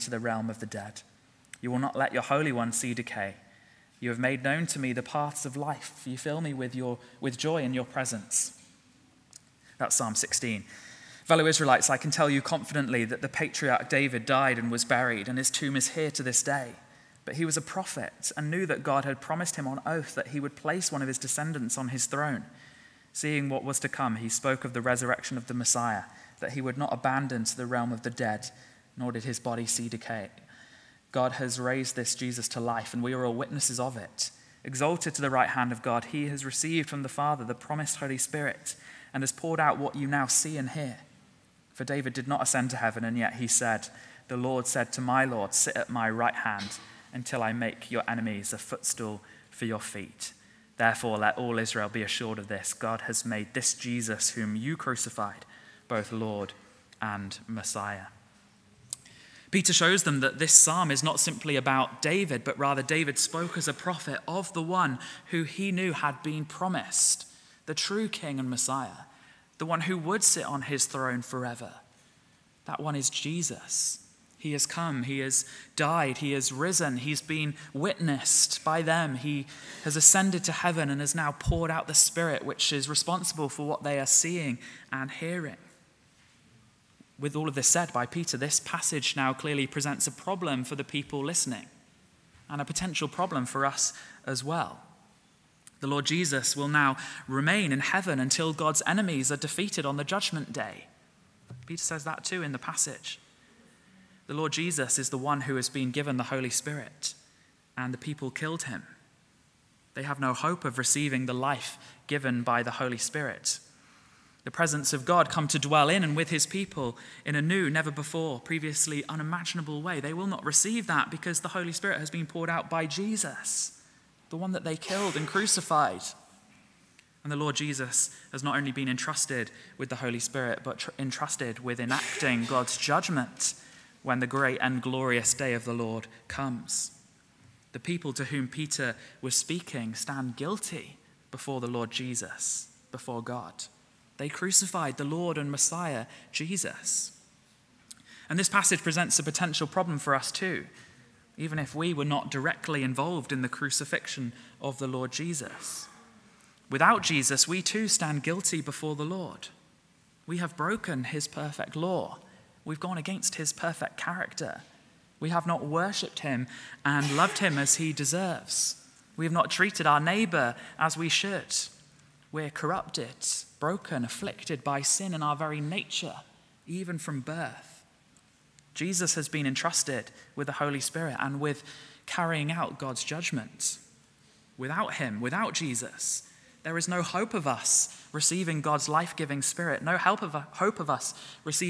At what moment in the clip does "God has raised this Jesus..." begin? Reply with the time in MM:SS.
00:31.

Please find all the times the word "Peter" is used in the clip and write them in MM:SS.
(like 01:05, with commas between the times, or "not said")
00:59, 01:28, 01:41, 02:18.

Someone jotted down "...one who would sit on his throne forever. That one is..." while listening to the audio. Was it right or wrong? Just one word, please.
right.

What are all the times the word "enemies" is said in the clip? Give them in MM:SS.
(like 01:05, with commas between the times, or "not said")
00:48, 01:38.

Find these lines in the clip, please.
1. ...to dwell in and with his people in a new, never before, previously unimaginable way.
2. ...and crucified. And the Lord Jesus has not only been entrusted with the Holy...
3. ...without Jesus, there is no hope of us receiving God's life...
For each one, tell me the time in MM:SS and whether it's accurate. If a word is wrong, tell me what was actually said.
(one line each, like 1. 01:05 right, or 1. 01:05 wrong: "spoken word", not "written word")
1. 01:55 right
2. 02:05 right
3. 03:05 right.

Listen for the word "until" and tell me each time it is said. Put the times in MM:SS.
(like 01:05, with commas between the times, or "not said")
00:47, 01:38.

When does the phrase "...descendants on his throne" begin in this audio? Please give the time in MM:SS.
00:21.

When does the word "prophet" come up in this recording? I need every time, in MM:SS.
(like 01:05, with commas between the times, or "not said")
00:17, 01:03.